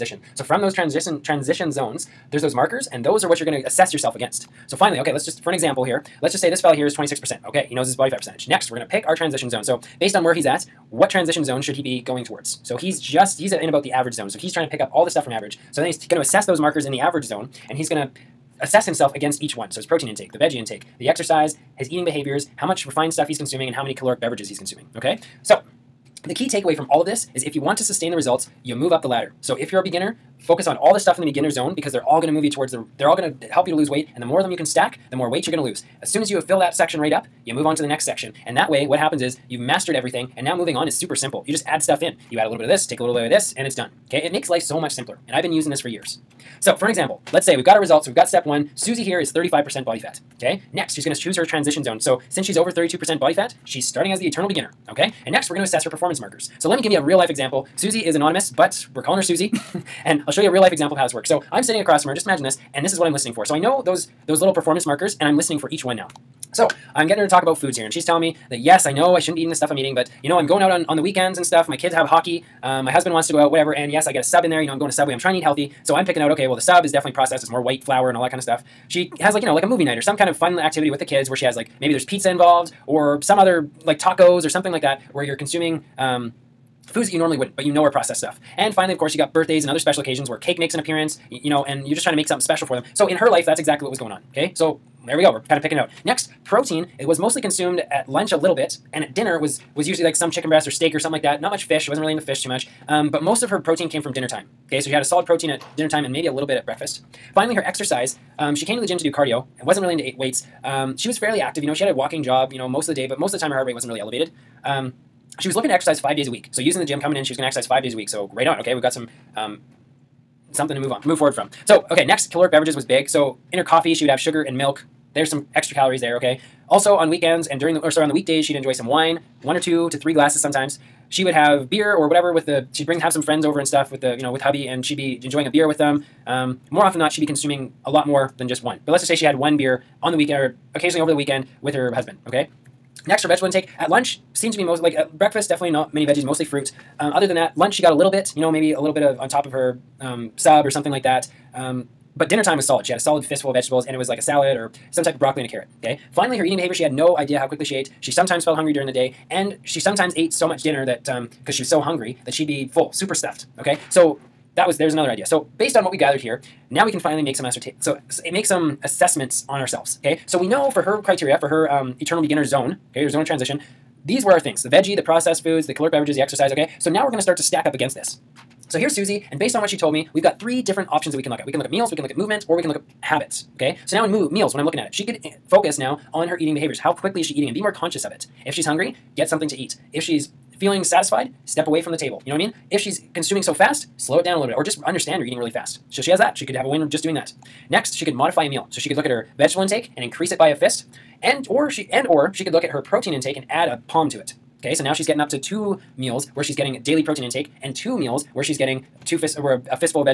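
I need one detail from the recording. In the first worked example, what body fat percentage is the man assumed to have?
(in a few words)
26%.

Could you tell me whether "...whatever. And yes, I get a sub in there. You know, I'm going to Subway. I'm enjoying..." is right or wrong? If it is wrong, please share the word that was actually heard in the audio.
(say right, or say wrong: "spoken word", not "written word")
wrong: "trying", not "enjoying".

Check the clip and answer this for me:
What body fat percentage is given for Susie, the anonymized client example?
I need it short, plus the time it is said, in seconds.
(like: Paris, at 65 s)
35%, at 49 s.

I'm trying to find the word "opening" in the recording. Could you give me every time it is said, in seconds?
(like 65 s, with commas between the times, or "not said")
not said.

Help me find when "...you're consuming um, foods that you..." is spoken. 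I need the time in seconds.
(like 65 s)
85 s.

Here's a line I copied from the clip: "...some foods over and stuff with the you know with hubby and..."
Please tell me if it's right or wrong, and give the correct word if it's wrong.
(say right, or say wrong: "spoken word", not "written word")
wrong: "friends", not "foods".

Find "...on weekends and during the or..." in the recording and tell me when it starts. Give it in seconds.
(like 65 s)
126 s.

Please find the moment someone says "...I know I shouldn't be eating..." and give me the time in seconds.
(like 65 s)
68 s.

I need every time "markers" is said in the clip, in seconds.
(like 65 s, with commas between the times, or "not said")
2 s, 16 s, 56 s, 64 s.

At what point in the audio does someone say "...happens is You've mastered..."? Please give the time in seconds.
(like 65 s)
38 s.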